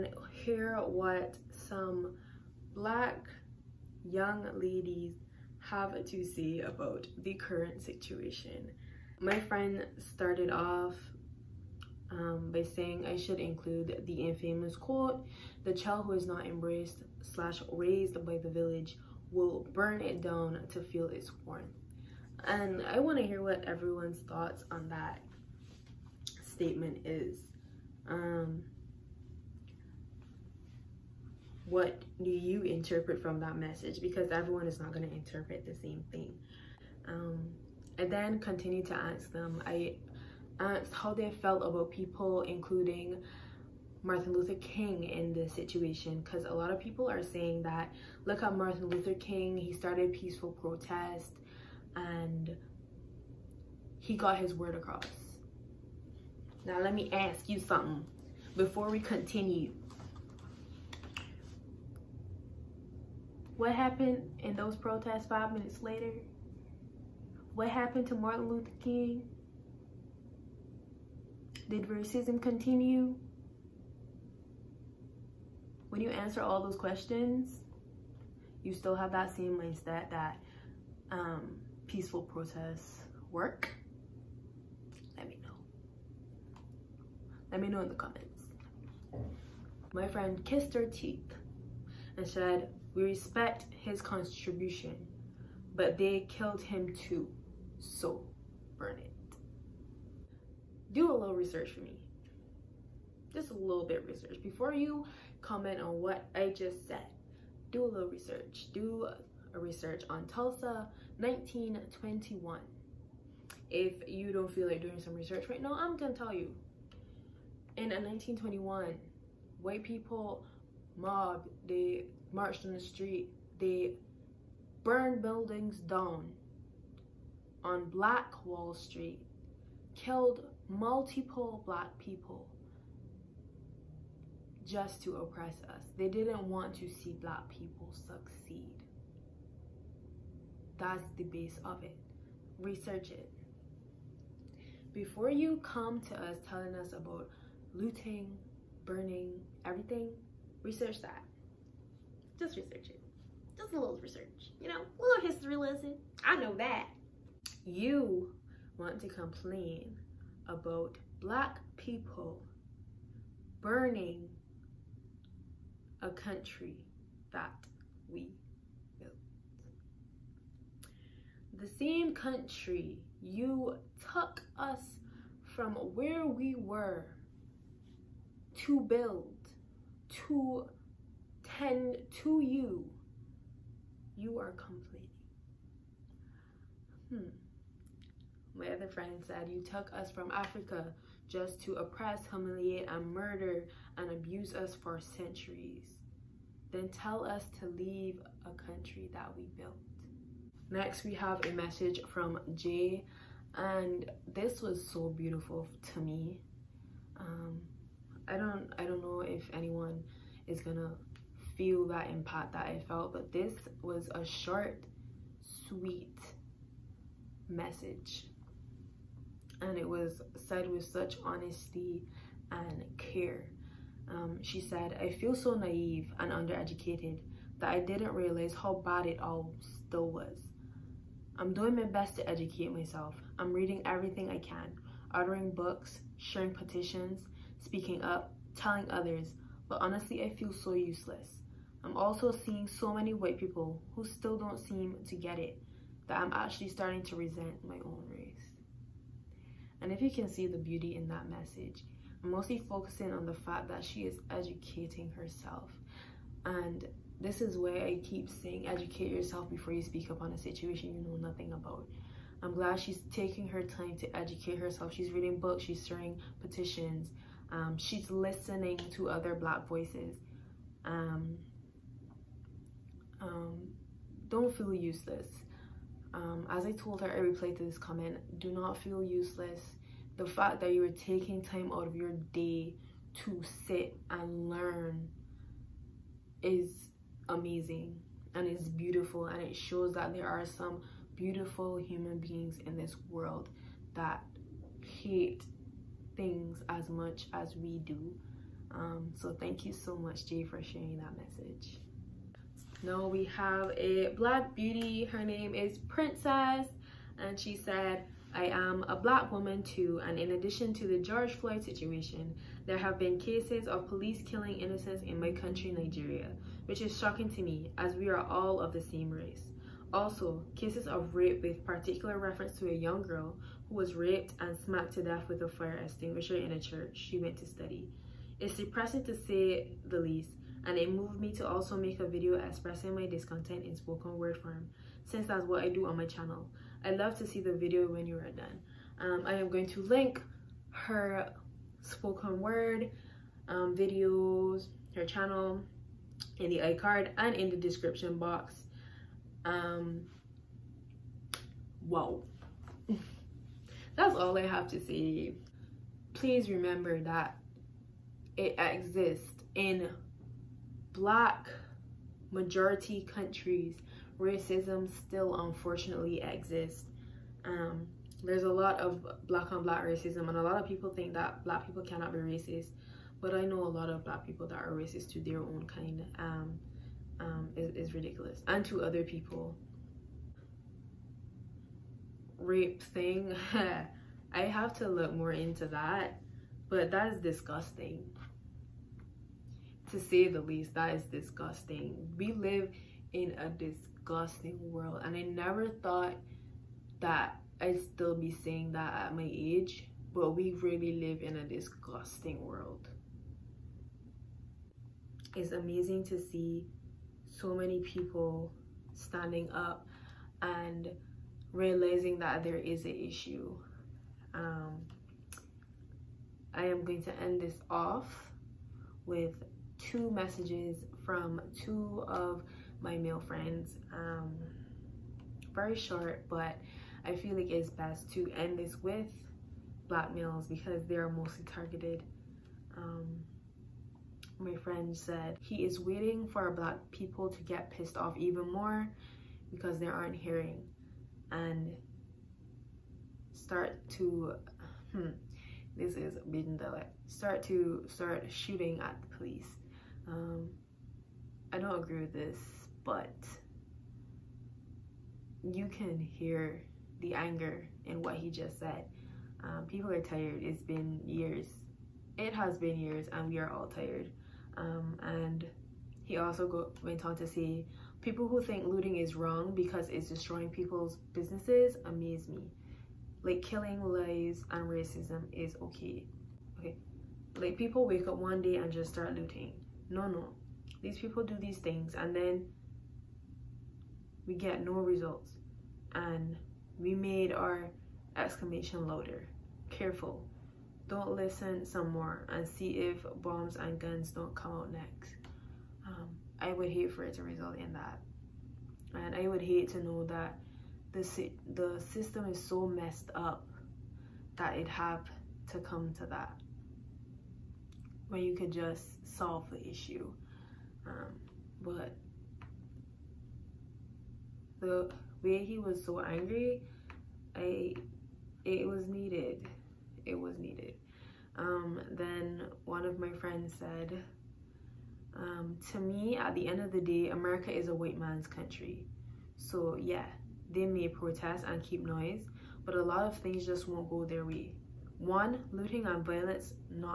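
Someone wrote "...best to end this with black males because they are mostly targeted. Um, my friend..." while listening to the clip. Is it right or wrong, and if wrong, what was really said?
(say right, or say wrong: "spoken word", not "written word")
right.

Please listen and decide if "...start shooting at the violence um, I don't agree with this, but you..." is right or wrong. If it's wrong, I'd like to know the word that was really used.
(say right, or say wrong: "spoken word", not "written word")
wrong: "police", not "violence".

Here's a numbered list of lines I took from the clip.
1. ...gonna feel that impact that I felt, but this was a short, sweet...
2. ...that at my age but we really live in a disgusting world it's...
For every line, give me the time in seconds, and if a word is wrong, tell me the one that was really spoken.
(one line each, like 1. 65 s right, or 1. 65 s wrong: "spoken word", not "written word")
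1. 210 s right
2. 398 s right.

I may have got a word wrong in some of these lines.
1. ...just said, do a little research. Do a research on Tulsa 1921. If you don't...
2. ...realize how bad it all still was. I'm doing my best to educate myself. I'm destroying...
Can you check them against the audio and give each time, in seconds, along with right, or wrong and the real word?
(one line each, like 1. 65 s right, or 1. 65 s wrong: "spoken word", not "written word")
1. 106 s right
2. 228 s wrong: "reading", not "destroying".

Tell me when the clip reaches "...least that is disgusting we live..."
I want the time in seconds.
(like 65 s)
390 s.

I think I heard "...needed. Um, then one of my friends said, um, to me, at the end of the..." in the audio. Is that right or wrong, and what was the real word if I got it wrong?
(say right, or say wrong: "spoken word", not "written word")
right.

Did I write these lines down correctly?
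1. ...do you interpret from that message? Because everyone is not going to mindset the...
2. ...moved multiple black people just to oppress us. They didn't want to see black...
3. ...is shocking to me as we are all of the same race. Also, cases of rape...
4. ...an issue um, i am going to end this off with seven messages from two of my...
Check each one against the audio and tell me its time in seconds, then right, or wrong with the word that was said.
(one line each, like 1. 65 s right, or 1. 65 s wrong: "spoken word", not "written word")
1. 32 s wrong: "interpret", not "mindset"
2. 129 s wrong: "killed", not "moved"
3. 316 s right
4. 412 s wrong: "two", not "seven".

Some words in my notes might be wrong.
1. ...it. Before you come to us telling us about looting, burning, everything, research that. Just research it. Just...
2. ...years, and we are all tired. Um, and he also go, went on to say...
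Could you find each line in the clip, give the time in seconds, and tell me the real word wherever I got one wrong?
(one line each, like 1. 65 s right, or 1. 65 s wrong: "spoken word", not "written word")
1. 143 s right
2. 462 s right.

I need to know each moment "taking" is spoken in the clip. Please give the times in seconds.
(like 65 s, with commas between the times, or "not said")
263 s, 280 s.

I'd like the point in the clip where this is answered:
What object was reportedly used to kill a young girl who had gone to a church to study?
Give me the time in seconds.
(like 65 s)
325 s.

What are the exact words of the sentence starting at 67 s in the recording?
What happened to Martin Luther King?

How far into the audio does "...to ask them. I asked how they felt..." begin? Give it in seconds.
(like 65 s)
38 s.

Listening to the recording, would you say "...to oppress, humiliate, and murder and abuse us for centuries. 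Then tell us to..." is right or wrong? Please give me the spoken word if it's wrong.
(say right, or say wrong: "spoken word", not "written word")
right.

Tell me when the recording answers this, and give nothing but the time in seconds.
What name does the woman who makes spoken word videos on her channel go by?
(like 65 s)
305 s.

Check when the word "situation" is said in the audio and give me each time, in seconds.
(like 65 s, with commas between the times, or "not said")
7 s, 45 s, 260 s, 311 s.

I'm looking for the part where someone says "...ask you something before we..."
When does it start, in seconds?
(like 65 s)
57 s.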